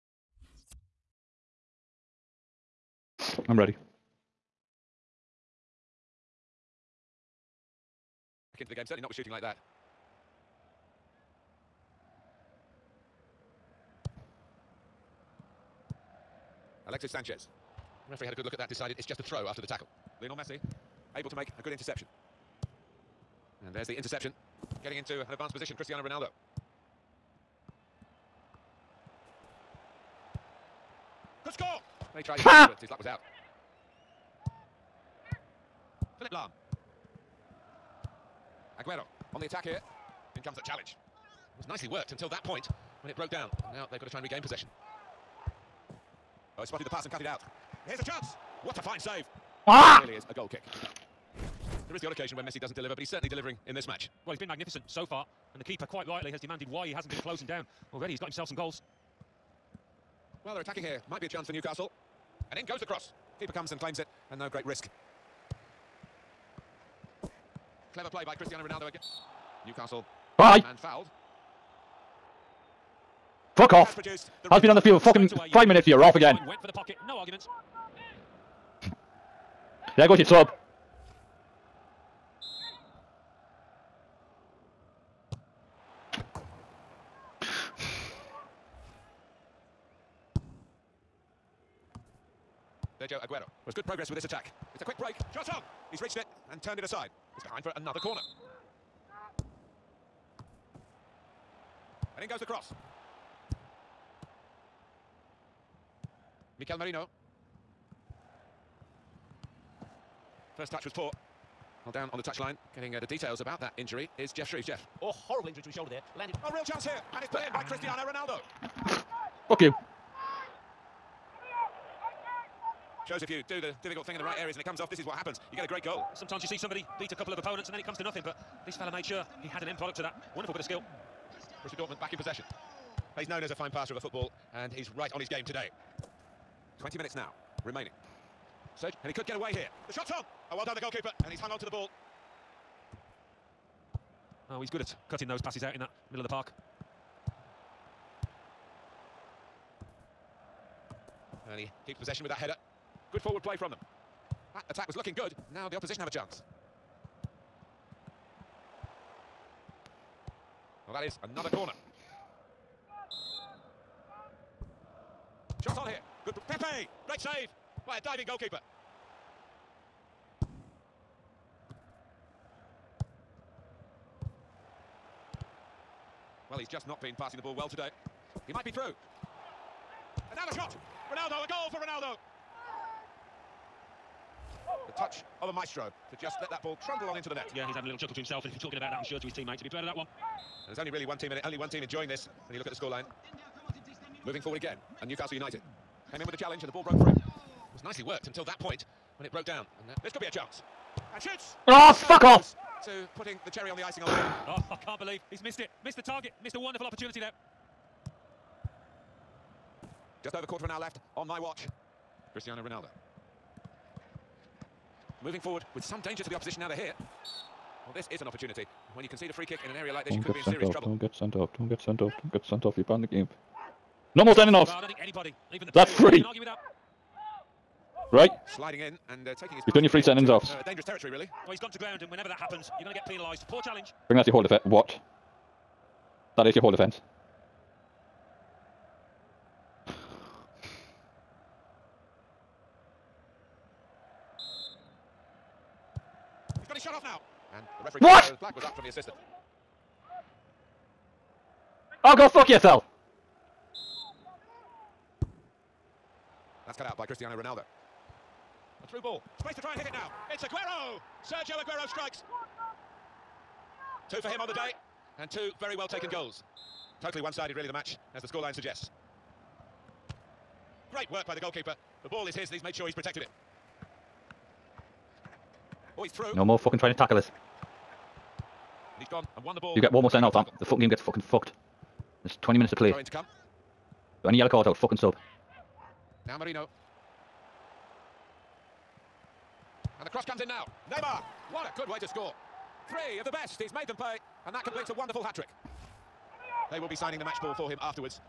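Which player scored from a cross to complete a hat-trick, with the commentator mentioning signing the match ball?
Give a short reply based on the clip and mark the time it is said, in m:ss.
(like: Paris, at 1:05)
Neymar, at 4:50.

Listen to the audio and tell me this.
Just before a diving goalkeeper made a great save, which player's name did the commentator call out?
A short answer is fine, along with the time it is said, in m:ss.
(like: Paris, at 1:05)
Pepe, at 2:46.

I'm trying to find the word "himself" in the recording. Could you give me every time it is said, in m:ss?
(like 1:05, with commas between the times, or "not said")
0:58, 3:08.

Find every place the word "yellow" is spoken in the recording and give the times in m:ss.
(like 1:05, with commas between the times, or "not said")
4:44.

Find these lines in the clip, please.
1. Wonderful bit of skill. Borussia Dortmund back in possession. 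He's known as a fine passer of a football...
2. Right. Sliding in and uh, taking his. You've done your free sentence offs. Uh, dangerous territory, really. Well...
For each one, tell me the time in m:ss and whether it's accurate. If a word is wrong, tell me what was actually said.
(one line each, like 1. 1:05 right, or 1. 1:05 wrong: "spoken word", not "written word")
1. 2:10 right
2. 3:48 right.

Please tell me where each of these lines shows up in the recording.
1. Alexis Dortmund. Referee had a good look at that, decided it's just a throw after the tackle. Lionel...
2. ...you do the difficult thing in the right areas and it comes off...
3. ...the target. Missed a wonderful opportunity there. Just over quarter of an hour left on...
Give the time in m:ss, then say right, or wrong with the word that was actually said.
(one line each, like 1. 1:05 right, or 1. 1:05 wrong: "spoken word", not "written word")
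1. 0:16 wrong: "Sanchez", not "Dortmund"
2. 2:03 right
3. 3:25 right.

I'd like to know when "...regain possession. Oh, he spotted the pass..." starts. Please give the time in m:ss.
0:44.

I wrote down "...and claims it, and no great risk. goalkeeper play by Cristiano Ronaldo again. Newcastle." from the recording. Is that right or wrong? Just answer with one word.
wrong.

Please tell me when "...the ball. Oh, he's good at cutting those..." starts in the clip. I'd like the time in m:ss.
2:21.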